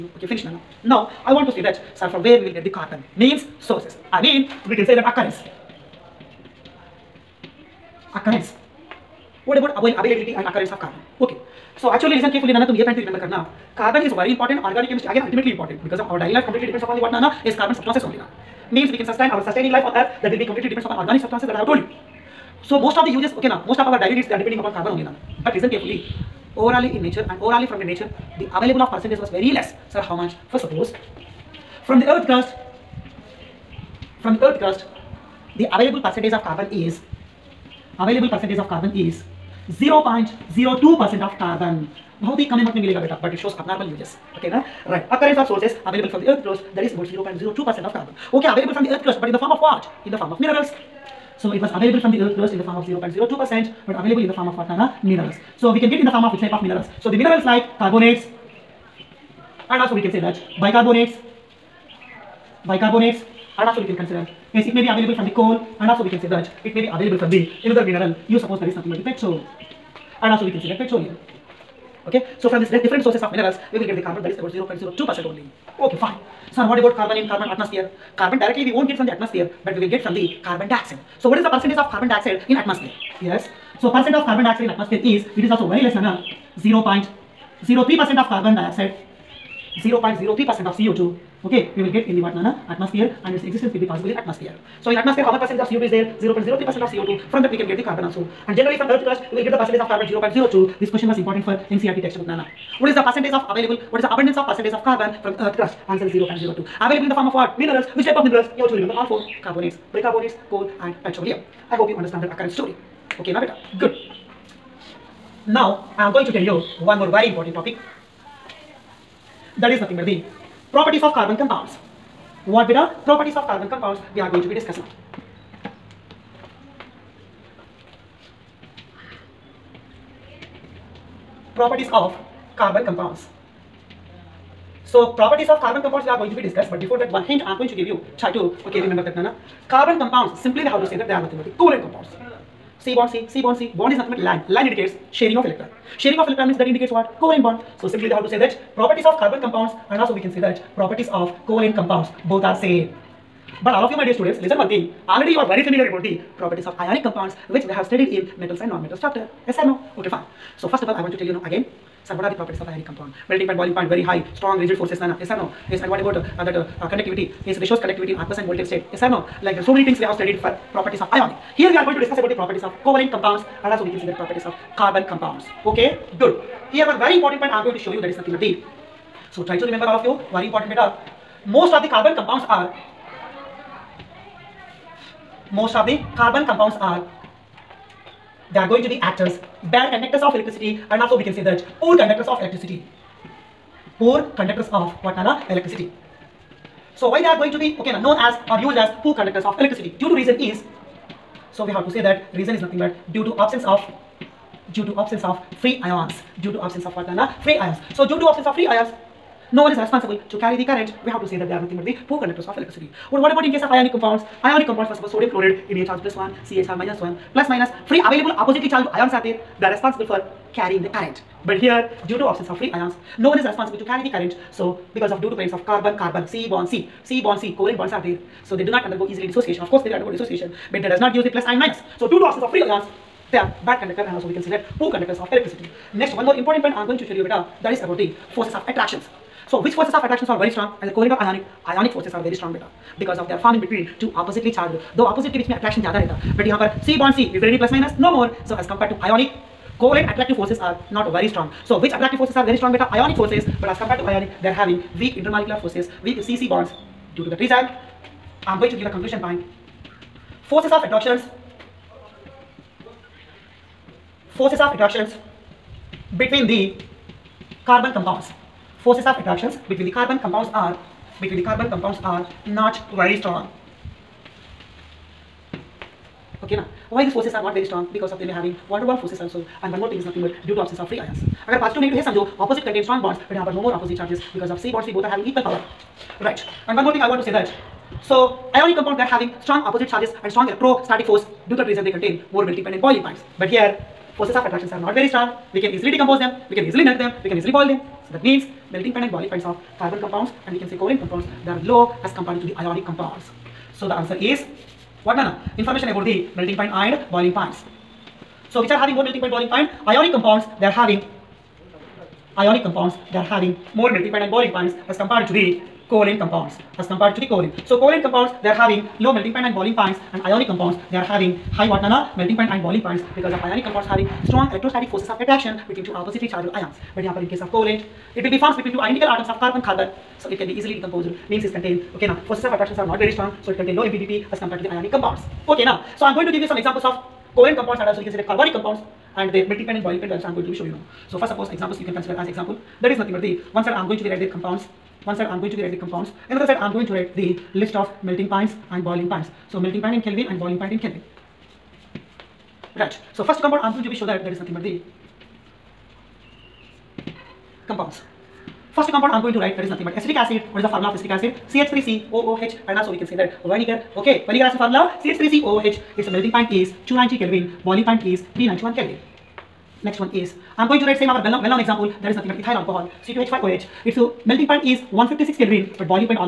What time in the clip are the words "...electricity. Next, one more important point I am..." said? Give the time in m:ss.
3:55.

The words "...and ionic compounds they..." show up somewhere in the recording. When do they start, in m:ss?
5:20.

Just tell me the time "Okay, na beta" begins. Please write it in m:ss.
1:53.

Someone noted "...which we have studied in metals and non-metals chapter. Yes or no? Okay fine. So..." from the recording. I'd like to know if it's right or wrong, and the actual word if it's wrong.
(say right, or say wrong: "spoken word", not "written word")
right.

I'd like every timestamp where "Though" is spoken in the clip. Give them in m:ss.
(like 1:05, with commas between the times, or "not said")
4:04.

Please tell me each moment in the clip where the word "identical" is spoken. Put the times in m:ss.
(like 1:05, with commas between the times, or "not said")
5:28.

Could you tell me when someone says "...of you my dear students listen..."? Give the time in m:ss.
2:33.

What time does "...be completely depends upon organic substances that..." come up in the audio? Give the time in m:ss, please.
0:20.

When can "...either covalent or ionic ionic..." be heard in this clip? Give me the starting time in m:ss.
4:00.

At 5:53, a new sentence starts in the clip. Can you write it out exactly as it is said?
So first compound I'm going to be show that that is nothing but the compounds.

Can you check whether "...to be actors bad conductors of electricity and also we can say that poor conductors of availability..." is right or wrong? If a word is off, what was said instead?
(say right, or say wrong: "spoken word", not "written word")
wrong: "electricity", not "availability".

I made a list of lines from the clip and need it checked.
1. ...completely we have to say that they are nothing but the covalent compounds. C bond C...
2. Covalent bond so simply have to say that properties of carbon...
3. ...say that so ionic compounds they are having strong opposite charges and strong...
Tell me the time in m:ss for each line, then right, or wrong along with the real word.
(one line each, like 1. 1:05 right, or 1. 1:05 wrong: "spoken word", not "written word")
1. 2:20 wrong: "simply", not "completely"
2. 2:27 right
3. 4:47 right.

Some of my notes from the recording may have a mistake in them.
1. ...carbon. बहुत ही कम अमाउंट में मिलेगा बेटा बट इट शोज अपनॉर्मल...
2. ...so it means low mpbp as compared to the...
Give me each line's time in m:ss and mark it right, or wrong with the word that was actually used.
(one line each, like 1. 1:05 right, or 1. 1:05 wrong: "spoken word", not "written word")
1. 0:41 right
2. 5:33 wrong: "contains", not "means".